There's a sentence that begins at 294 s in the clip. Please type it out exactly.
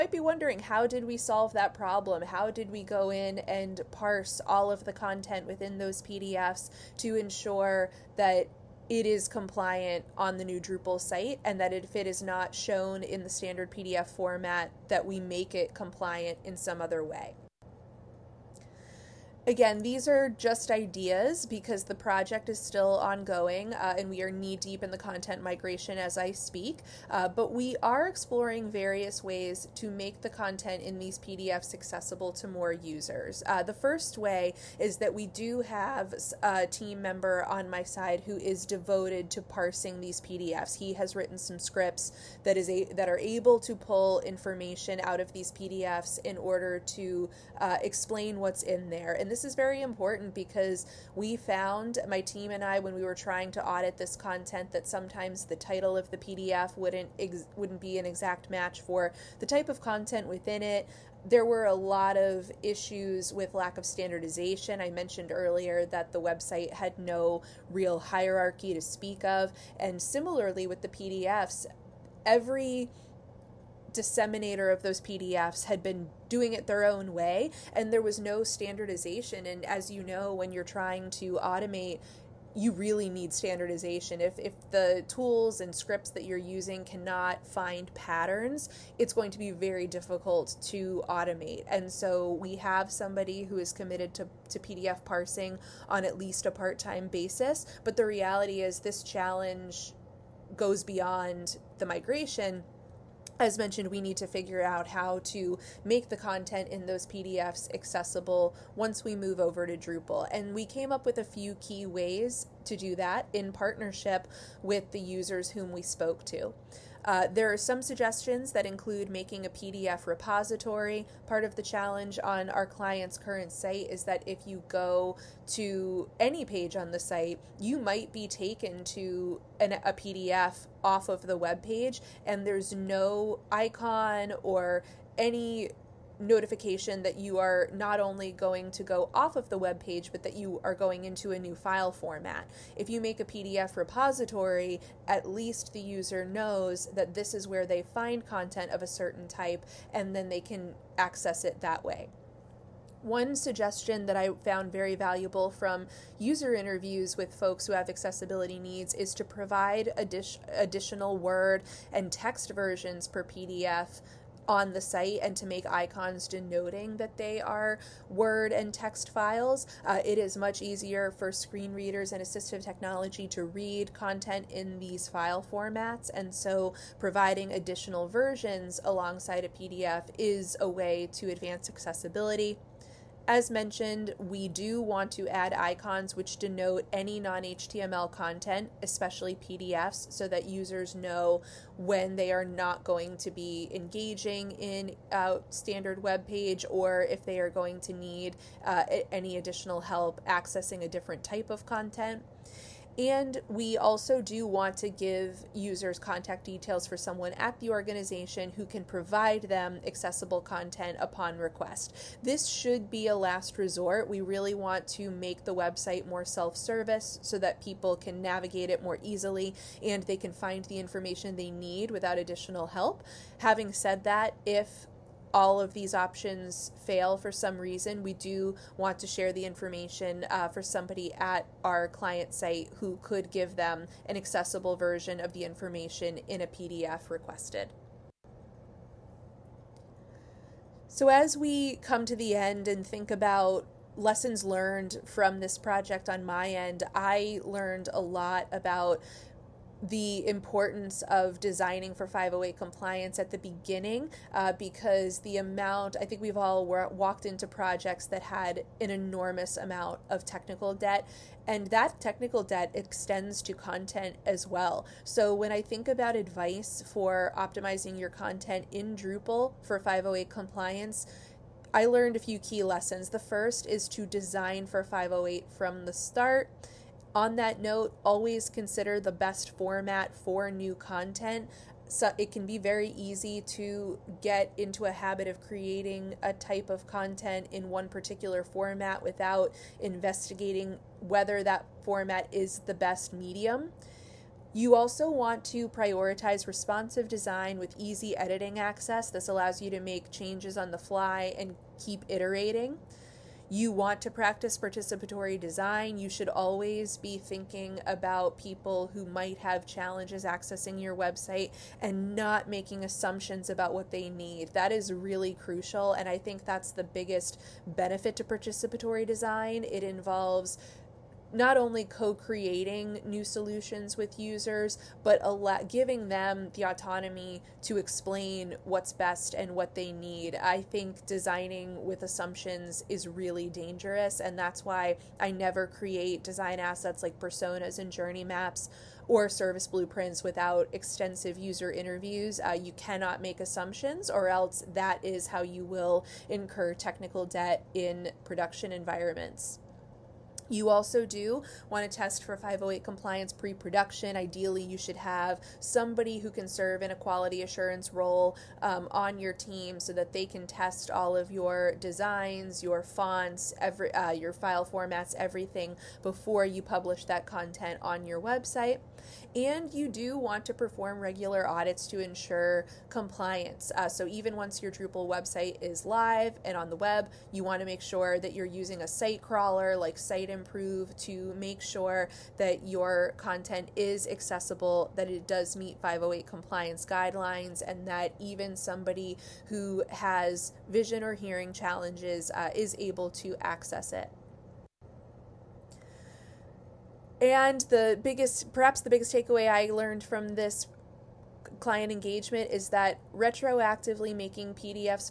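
You also want to prioritize responsive design with easy editing access.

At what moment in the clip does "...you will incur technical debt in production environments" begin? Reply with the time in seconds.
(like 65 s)
345 s.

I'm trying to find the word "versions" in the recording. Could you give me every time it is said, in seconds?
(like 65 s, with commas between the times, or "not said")
162 s, 178 s, 234 s.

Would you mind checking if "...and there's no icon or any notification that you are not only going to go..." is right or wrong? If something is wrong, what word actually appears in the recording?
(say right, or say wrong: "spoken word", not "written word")
right.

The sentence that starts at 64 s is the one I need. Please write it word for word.
I mentioned earlier that the website had no real hierarchy to speak of.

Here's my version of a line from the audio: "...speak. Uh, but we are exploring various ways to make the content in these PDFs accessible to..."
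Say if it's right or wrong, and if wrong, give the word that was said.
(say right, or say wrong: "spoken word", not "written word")
right.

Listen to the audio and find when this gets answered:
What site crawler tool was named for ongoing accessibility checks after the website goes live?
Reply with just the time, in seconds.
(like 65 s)
379 s.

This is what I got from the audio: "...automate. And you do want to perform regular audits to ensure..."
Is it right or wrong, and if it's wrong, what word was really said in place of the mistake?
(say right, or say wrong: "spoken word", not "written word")
wrong: "website", not "automate".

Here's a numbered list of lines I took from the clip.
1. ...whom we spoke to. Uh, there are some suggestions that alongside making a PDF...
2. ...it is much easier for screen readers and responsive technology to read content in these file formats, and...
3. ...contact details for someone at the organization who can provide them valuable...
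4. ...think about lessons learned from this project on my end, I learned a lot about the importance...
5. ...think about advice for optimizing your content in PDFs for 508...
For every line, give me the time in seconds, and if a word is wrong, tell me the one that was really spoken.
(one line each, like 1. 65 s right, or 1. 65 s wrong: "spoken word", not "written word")
1. 115 s wrong: "include", not "alongside"
2. 170 s wrong: "assistive", not "responsive"
3. 205 s wrong: "accessible", not "valuable"
4. 242 s right
5. 265 s wrong: "Drupal", not "PDFs".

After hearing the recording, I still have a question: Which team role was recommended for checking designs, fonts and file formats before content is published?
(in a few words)
quality assurance.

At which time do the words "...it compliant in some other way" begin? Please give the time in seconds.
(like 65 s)
15 s.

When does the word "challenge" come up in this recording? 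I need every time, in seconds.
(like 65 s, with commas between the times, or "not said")
99 s, 121 s, 309 s, 391 s.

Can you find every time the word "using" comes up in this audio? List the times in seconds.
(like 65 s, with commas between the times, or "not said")
86 s, 378 s.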